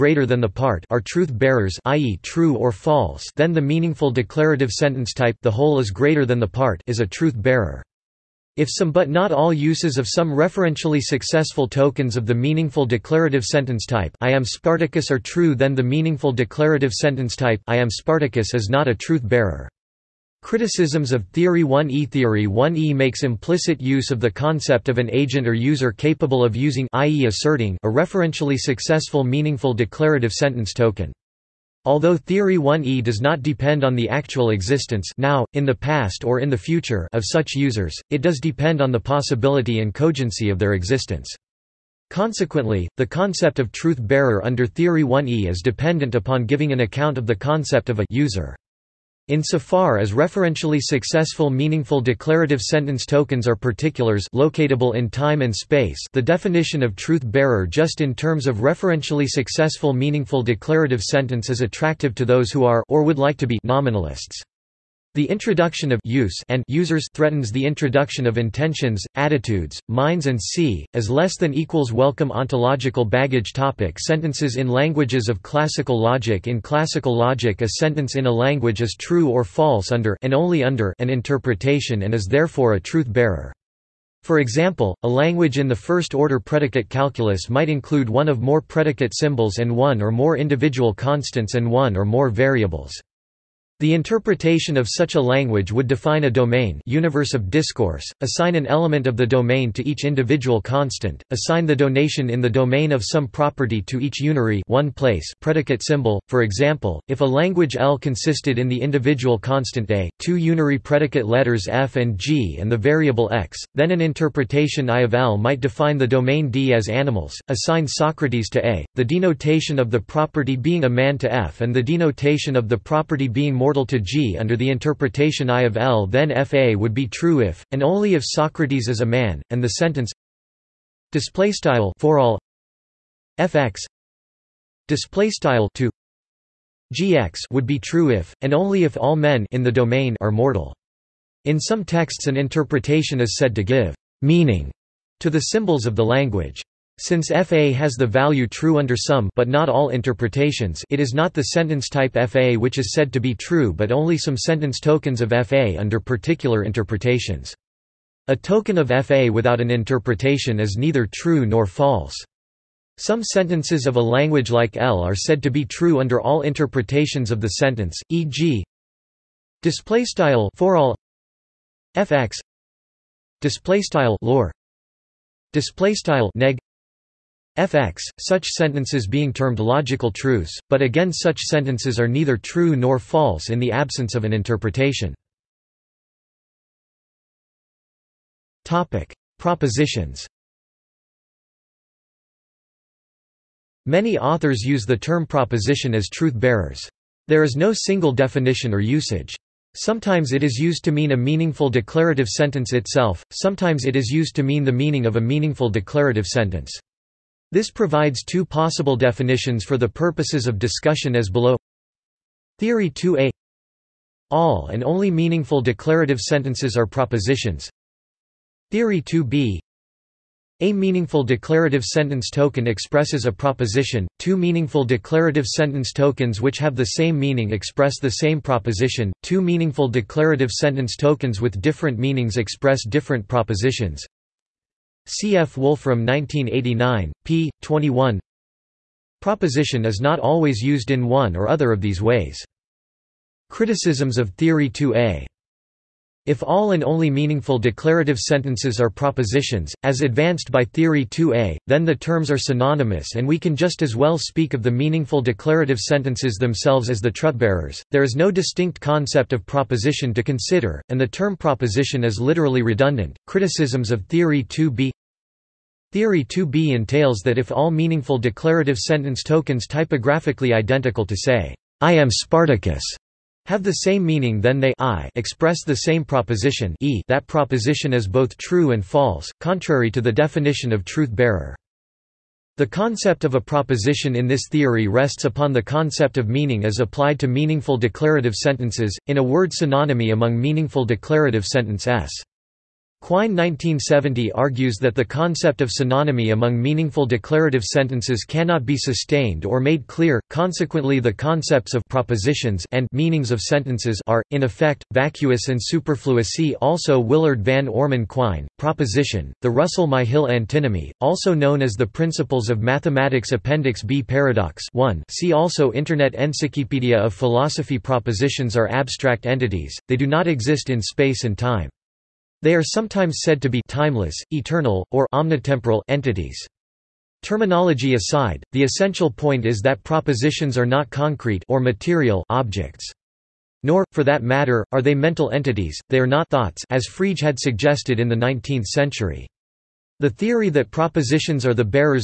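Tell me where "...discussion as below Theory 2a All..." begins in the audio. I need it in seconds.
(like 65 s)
210 s.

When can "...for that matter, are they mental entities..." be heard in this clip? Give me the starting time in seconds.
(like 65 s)
333 s.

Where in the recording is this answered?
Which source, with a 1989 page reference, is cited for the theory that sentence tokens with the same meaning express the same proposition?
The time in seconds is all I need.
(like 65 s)
235 s.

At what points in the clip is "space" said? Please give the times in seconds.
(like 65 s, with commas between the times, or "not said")
55 s, 320 s.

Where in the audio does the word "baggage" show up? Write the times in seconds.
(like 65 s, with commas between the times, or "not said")
73 s.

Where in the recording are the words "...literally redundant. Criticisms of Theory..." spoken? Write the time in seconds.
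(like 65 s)
262 s.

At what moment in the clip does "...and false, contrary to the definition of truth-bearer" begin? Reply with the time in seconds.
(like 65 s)
278 s.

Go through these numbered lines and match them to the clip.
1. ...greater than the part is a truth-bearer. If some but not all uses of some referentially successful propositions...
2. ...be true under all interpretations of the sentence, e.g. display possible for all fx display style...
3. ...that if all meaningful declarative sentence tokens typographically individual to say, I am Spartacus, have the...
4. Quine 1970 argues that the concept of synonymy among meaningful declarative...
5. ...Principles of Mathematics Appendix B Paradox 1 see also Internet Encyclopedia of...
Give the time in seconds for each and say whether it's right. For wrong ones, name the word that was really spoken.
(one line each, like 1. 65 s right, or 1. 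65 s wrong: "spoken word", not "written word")
1. 5 s wrong: "tokens", not "propositions"
2. 165 s wrong: "style", not "possible"
3. 267 s wrong: "identical", not "individual"
4. 293 s right
5. 311 s right.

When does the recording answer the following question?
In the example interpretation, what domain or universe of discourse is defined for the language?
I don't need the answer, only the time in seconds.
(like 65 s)
116 s.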